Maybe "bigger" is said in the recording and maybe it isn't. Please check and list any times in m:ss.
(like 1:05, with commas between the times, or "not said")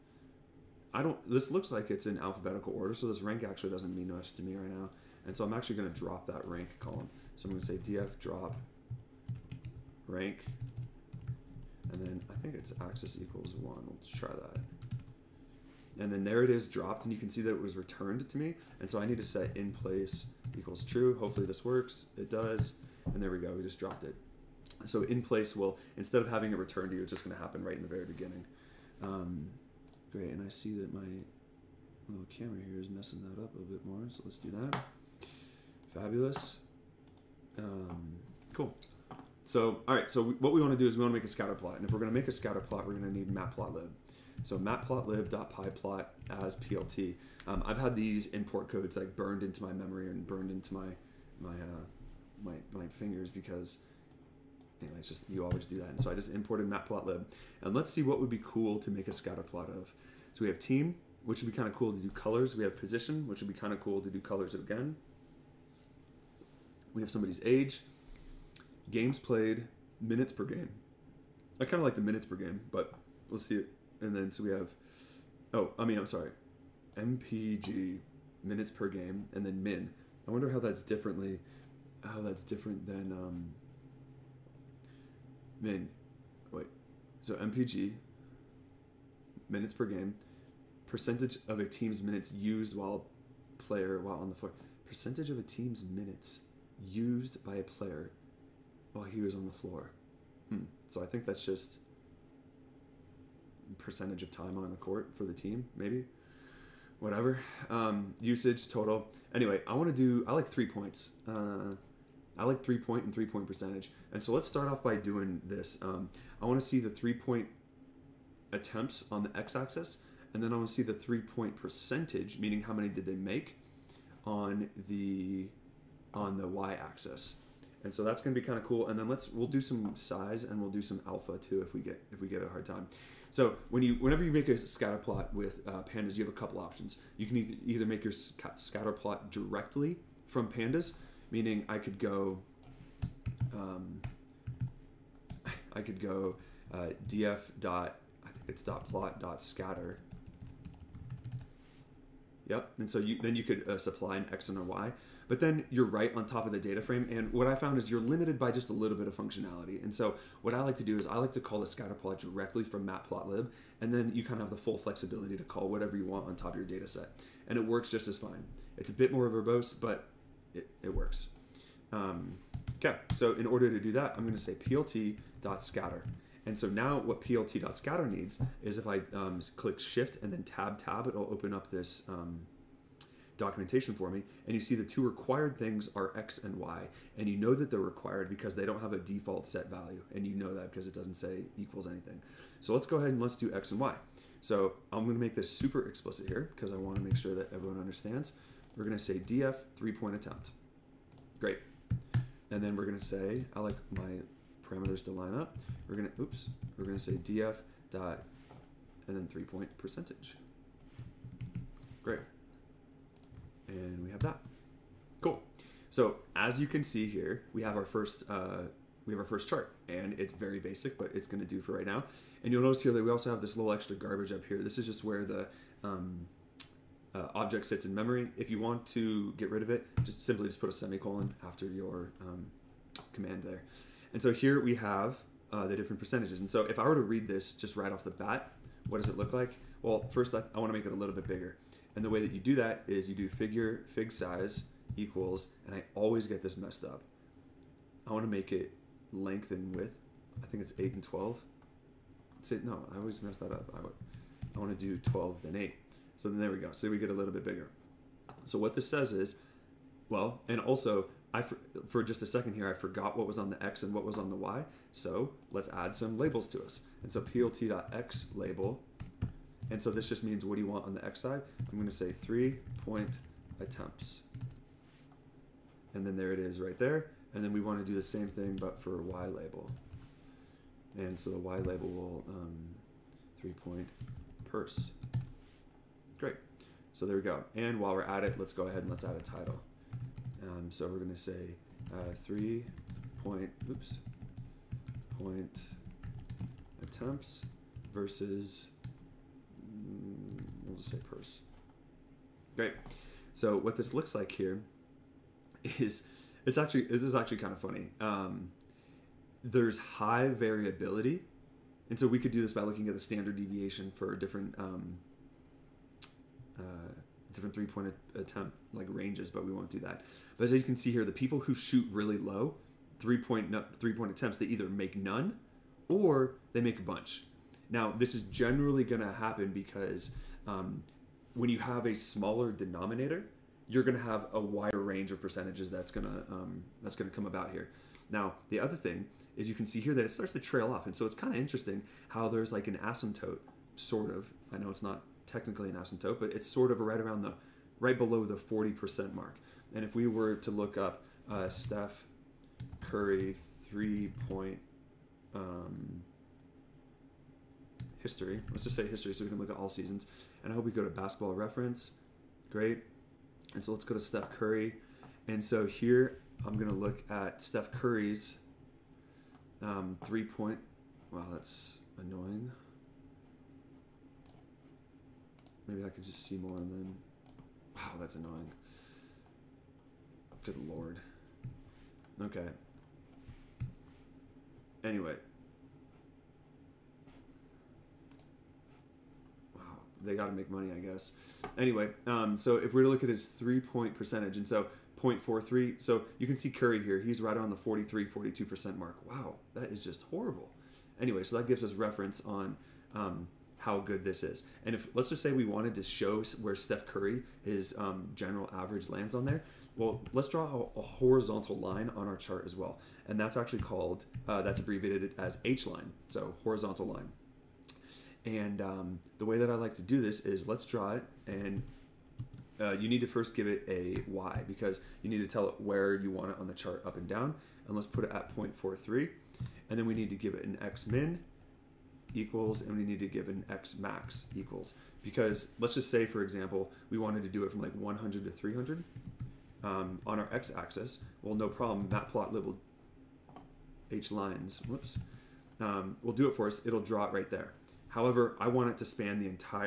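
4:01, 4:17.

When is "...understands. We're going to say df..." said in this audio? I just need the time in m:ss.
3:17.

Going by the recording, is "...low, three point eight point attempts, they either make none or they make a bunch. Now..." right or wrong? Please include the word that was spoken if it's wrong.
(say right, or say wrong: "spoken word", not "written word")
wrong: "three", not "eight".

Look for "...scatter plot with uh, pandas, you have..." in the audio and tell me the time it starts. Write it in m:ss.
2:14.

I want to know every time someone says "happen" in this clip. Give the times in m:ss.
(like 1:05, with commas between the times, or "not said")
0:27, 5:29.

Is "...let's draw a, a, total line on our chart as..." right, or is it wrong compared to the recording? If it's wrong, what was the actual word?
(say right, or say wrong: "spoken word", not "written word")
wrong: "horizontal", not "total".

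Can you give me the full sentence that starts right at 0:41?
And if we're going to make a scatter plot, we're going to need matplotlib.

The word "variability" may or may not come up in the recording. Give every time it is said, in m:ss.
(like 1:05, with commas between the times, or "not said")
5:10.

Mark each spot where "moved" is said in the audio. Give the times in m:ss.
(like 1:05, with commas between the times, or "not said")
not said.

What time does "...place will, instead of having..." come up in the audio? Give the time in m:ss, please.
0:25.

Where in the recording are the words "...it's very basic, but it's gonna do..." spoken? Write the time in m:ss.
3:40.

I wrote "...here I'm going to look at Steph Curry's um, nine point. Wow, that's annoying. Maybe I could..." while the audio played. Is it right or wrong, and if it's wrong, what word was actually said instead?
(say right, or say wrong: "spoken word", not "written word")
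wrong: "three", not "nine".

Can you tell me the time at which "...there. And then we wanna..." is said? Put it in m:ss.
4:36.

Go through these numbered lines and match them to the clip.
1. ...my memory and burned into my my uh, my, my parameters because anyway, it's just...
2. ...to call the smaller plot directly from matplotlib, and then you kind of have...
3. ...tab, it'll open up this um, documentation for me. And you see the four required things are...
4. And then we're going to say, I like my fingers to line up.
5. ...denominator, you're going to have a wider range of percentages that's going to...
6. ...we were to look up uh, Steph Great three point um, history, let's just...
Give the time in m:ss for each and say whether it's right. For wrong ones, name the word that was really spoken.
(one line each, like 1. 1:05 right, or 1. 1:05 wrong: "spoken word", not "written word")
1. 0:49 wrong: "fingers", not "parameters"
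2. 2:41 wrong: "scatter", not "smaller"
3. 3:00 wrong: "two", not "four"
4. 3:22 wrong: "parameters", not "fingers"
5. 5:32 right
6. 5:49 wrong: "Curry", not "Great".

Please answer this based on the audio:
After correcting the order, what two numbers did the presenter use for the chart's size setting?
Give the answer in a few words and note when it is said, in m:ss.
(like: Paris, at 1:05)
12 and 8, at 4:15.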